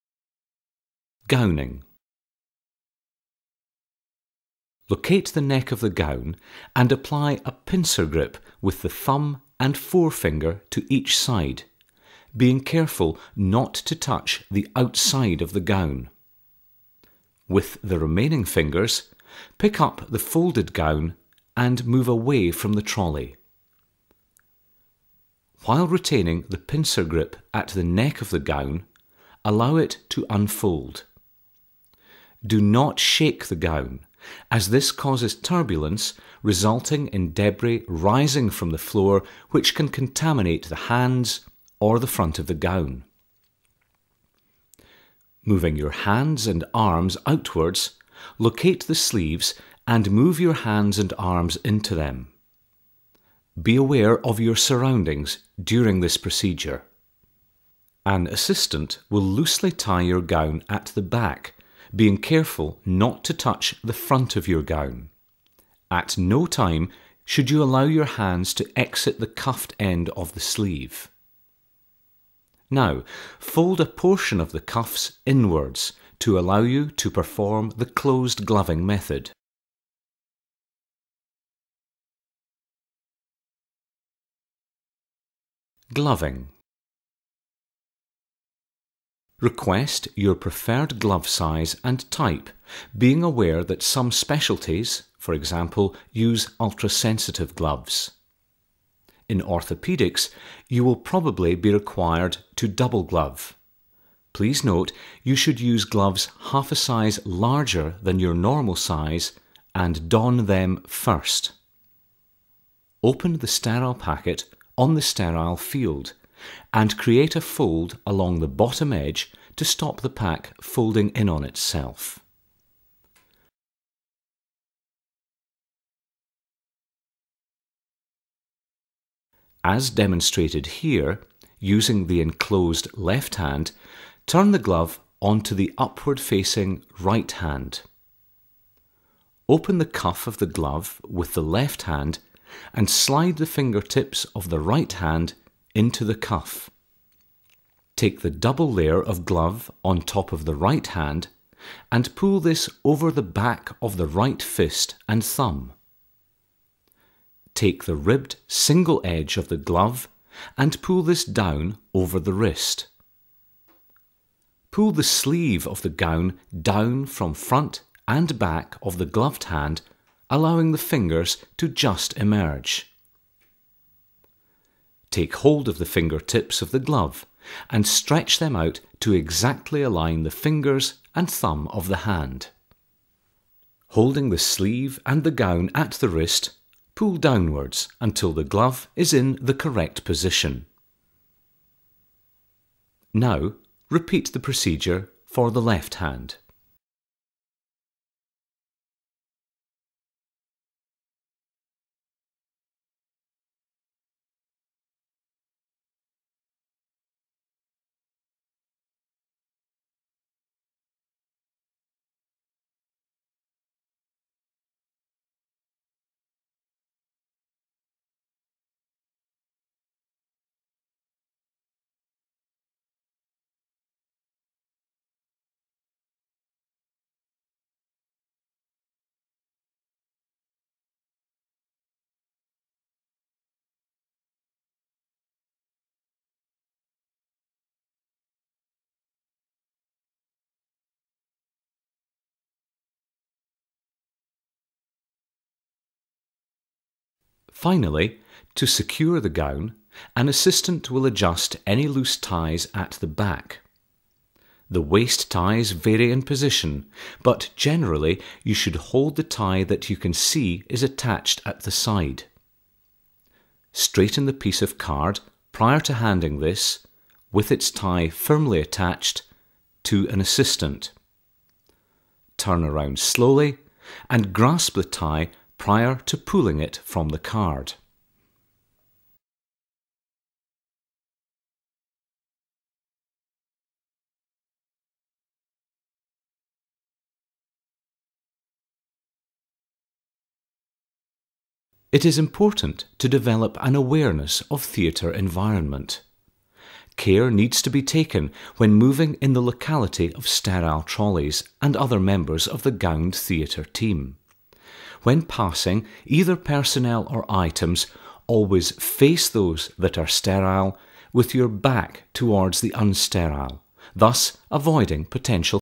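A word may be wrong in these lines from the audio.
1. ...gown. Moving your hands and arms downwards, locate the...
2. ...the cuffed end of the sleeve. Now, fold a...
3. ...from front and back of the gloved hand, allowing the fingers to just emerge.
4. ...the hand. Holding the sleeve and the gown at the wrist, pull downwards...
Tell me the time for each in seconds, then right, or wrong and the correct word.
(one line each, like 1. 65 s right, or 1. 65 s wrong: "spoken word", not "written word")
1. 42 s wrong: "outwards", not "downwards"
2. 69 s right
3. 167 s right
4. 181 s right.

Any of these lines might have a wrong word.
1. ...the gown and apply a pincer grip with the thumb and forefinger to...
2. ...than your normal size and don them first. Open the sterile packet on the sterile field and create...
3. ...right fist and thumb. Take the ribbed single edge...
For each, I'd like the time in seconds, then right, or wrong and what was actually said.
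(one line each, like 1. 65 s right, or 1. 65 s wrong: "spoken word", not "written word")
1. 5 s right
2. 108 s right
3. 154 s right.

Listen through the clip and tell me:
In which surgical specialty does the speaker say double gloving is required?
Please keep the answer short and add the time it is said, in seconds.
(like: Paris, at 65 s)
orthopedics, at 99 s.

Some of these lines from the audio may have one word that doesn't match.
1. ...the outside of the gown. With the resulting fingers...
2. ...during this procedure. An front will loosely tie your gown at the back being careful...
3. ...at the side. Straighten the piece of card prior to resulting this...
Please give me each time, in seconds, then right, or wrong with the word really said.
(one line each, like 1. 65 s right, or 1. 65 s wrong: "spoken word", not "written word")
1. 14 s wrong: "remaining", not "resulting"
2. 55 s wrong: "assistant", not "front"
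3. 261 s wrong: "handing", not "resulting".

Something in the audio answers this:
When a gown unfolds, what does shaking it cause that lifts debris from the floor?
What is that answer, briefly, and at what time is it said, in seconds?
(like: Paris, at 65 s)
turbulence, at 35 s.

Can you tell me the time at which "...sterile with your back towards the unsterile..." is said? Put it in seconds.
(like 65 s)
310 s.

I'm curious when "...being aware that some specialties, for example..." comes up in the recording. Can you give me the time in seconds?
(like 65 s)
92 s.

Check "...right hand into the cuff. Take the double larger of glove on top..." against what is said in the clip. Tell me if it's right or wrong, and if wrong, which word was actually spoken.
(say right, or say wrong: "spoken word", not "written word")
wrong: "layer", not "larger".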